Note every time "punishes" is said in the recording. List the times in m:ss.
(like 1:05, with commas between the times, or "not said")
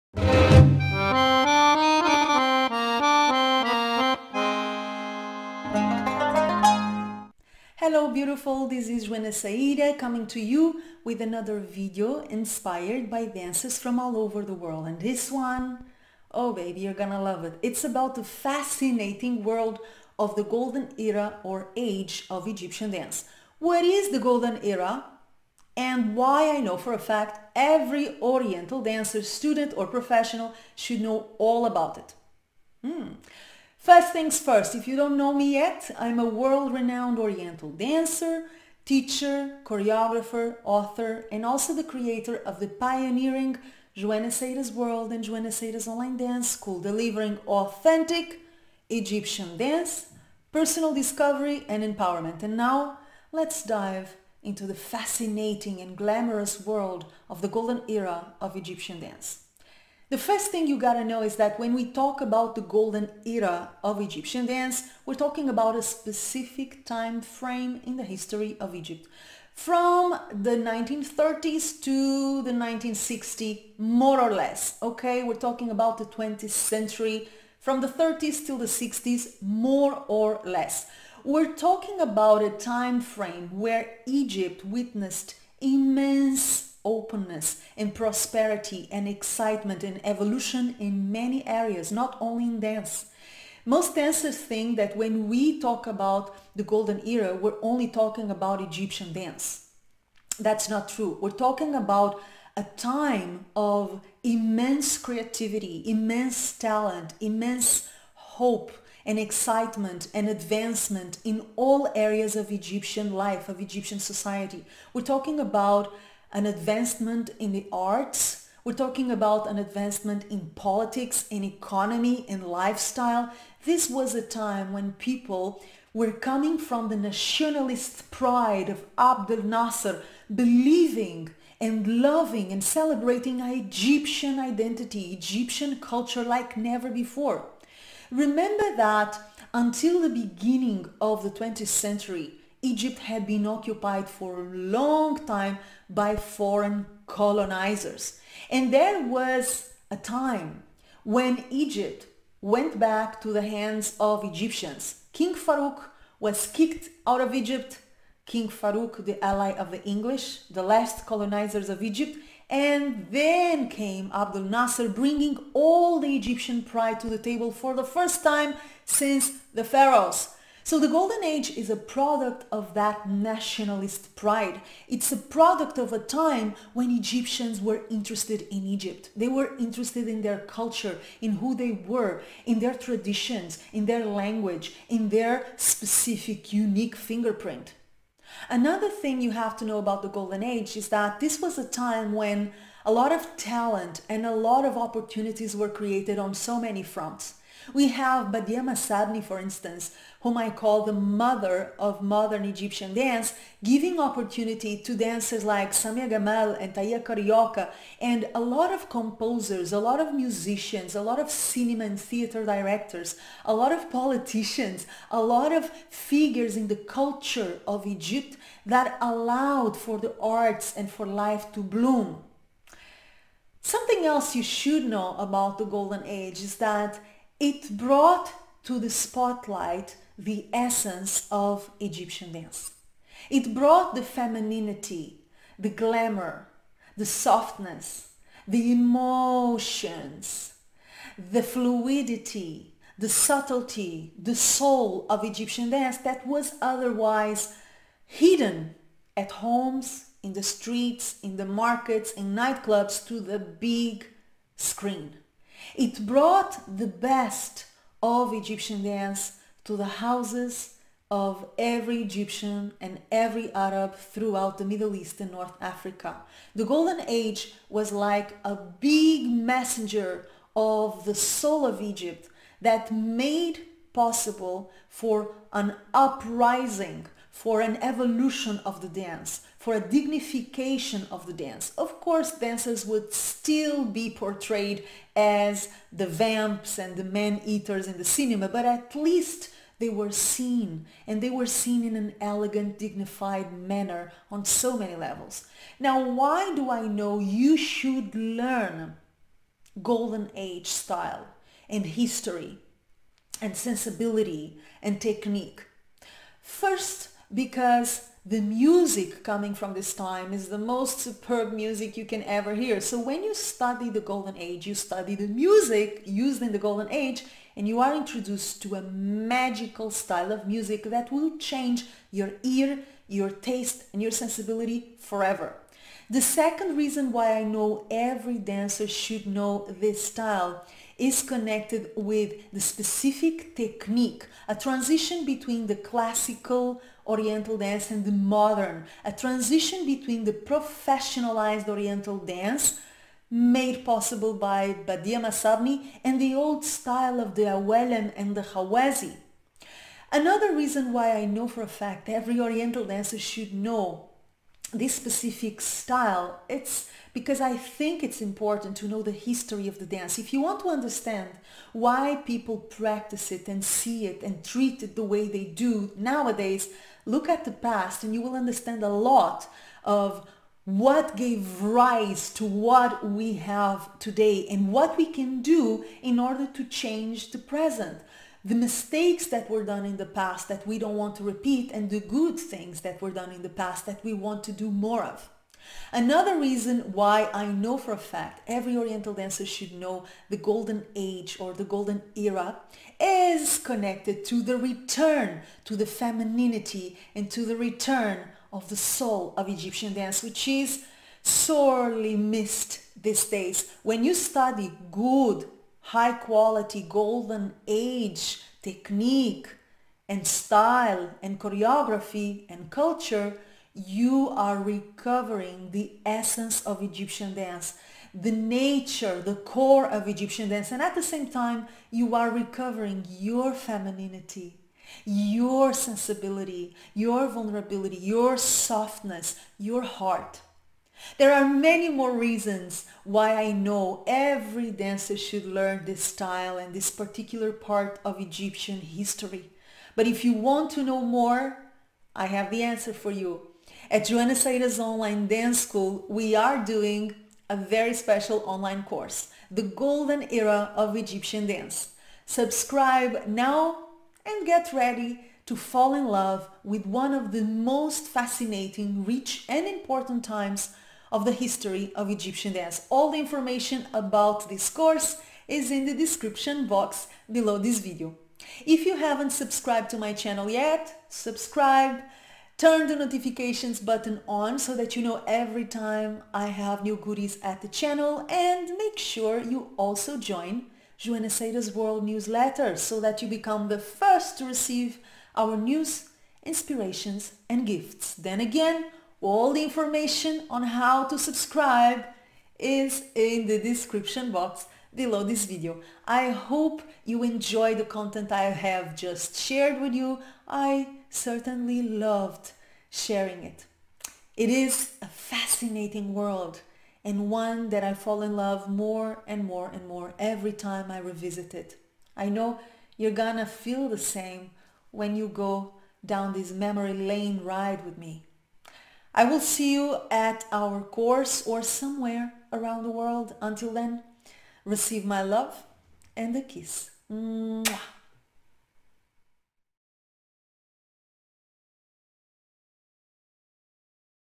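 not said.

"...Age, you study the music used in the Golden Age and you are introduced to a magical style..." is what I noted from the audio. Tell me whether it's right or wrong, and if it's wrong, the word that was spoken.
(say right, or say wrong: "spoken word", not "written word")
right.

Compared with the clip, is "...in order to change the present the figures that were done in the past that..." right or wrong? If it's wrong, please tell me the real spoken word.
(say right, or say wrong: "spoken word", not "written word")
wrong: "mistakes", not "figures".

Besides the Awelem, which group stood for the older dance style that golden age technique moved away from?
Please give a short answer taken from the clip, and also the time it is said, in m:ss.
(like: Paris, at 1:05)
Ghawazi, at 5:48.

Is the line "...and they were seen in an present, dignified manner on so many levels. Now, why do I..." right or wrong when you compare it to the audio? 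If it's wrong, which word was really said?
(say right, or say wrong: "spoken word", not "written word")
wrong: "elegant", not "present".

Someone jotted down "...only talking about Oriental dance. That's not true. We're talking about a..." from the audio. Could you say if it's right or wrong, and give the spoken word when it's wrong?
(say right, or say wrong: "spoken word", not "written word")
wrong: "Egyptian", not "Oriental".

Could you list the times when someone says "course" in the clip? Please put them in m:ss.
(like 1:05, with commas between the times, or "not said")
4:42, 7:28, 7:44, 8:40.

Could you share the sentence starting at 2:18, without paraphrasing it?
Remember that until the beginning of the 20th century, Egypt had been occupied for a long time by foreign colonizers.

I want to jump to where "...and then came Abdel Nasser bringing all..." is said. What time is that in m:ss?
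2:42.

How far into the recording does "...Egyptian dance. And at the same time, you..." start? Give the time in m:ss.
7:00.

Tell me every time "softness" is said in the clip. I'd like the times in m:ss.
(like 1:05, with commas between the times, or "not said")
3:57, 7:08.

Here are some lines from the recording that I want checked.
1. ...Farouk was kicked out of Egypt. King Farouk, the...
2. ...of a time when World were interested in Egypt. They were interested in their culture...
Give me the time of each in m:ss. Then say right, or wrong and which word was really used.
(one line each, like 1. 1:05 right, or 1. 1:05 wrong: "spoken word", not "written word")
1. 2:35 right
2. 2:55 wrong: "Egyptians", not "World".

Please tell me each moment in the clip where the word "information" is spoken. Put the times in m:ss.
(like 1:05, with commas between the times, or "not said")
7:43, 8:09.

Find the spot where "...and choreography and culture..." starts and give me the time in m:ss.
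6:51.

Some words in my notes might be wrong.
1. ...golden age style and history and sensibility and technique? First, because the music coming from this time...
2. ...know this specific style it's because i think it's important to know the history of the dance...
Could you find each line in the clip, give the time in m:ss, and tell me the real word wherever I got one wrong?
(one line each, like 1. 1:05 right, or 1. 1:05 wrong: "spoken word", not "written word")
1. 4:59 right
2. 5:53 right.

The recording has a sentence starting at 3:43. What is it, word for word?
Something else you should know about the Golden Age is that it brought to the spotlight the essence of Egyptian dance.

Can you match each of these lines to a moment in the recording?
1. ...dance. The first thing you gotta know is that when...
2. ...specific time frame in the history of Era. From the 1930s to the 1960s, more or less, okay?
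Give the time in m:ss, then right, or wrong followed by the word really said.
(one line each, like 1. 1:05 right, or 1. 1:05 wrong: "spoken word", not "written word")
1. 0:58 right
2. 1:05 wrong: "Egypt", not "Era".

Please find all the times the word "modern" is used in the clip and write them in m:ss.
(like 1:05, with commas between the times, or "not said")
3:22, 5:38.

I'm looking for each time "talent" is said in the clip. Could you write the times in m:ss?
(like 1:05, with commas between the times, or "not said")
1:46, 3:13.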